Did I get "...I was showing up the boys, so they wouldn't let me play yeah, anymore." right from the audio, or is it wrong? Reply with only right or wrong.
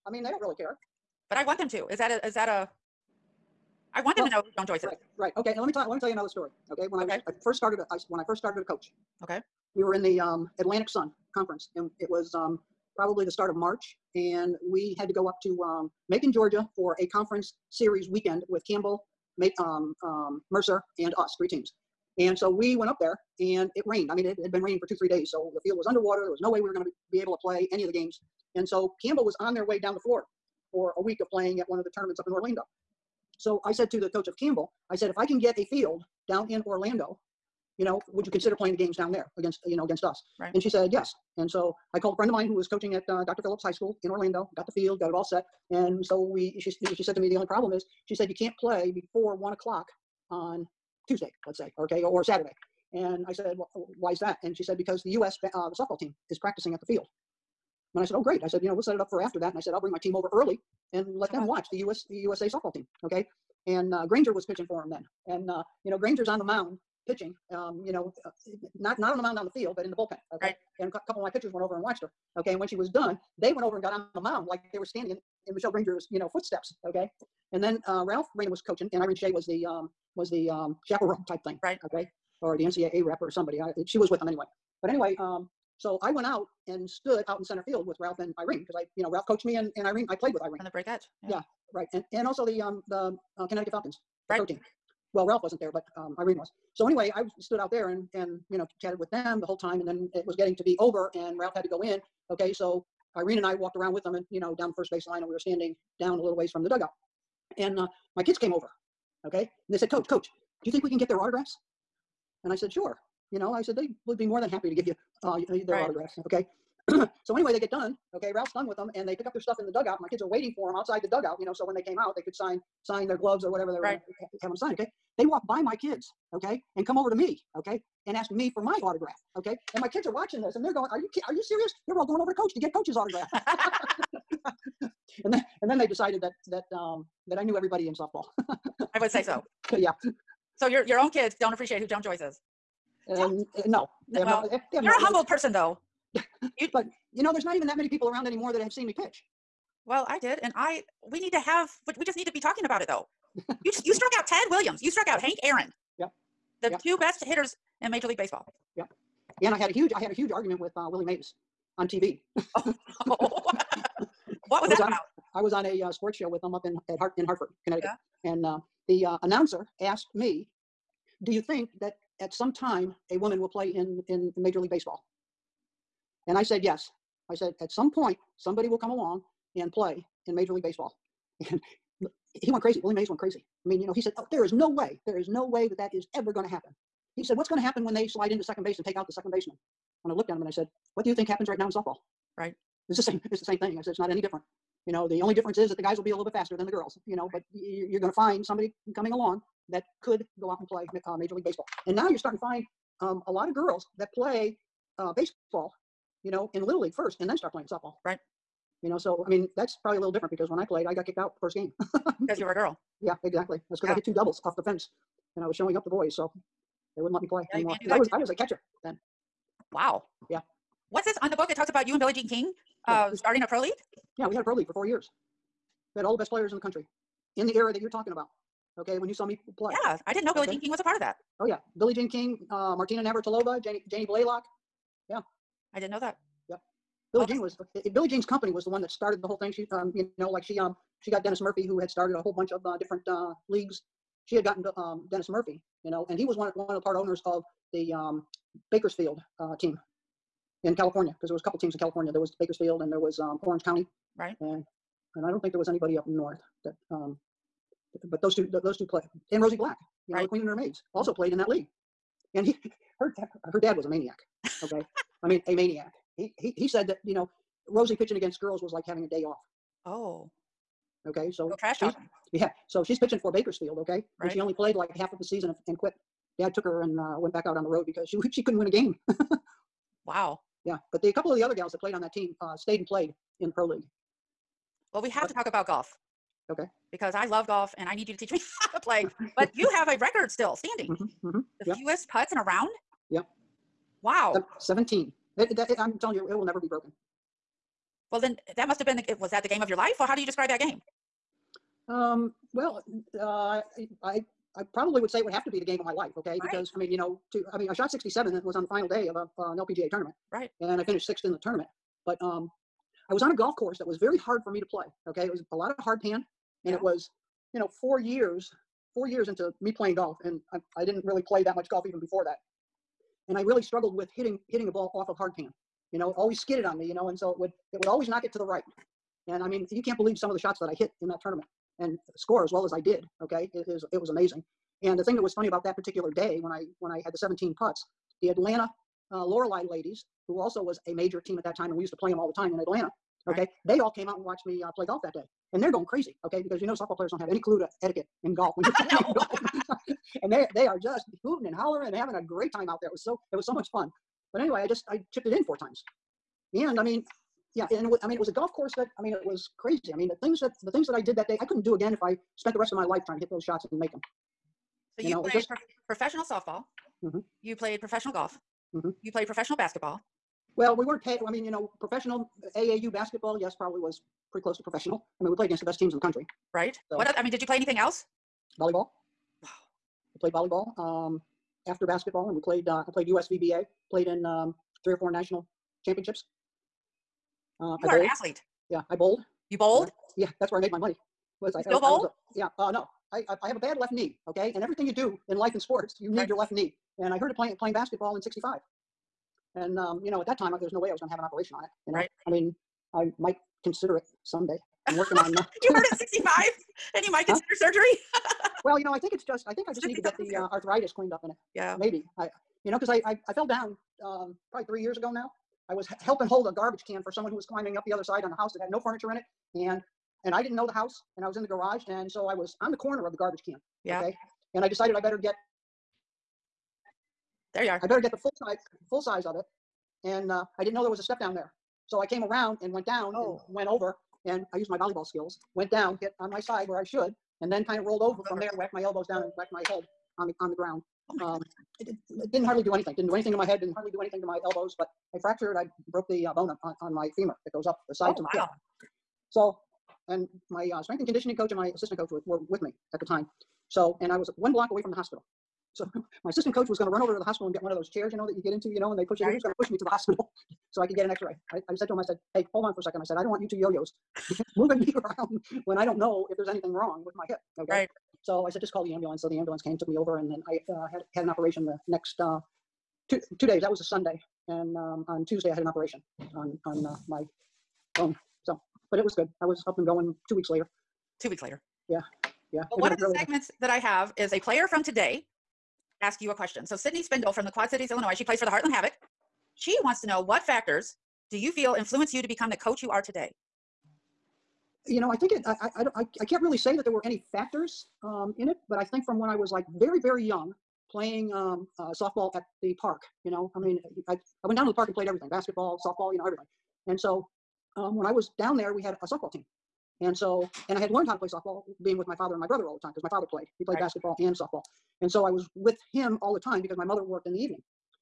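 right.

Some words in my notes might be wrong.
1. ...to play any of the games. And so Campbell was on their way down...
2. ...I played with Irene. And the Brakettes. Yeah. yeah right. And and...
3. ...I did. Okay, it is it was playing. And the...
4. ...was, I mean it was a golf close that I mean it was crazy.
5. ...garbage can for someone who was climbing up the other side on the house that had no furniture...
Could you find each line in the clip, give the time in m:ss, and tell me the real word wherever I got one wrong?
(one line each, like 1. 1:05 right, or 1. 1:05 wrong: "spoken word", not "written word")
1. 0:27 right
2. 1:30 right
3. 5:32 wrong: "amazing", not "playing"
4. 5:57 wrong: "course", not "close"
5. 6:56 right.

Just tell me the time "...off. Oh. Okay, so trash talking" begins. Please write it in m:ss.
4:29.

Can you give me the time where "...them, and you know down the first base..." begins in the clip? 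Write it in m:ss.
1:44.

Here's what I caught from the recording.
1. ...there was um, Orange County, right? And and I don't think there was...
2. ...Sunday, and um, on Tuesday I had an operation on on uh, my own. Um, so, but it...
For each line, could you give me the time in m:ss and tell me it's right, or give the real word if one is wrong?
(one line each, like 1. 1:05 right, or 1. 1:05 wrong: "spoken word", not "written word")
1. 4:12 right
2. 7:53 right.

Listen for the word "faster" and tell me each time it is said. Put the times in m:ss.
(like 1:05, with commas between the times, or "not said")
3:16.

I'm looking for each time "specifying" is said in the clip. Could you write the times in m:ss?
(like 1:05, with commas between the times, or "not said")
not said.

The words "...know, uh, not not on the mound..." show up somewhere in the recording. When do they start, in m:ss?
1:07.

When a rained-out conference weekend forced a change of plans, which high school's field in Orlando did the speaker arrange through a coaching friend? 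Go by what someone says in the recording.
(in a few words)
Dr. Phillips High School.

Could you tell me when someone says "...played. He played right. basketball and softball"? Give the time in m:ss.
8:33.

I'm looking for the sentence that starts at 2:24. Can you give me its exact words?
Uh, they have You're no a humbled person, though.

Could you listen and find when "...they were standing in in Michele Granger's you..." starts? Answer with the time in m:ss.
1:14.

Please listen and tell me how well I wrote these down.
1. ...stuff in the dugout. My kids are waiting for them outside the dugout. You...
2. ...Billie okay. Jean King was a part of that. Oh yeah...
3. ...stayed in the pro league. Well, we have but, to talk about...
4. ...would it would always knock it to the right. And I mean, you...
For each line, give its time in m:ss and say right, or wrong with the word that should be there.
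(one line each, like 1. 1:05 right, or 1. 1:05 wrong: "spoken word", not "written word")
1. 1:59 right
2. 3:50 right
3. 4:42 wrong: "played", not "stayed"
4. 5:27 right.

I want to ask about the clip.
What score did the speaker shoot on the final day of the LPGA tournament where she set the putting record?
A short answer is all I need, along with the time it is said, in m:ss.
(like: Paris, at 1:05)
67, at 5:07.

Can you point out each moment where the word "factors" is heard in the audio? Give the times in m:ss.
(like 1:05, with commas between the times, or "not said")
8:10, 8:17.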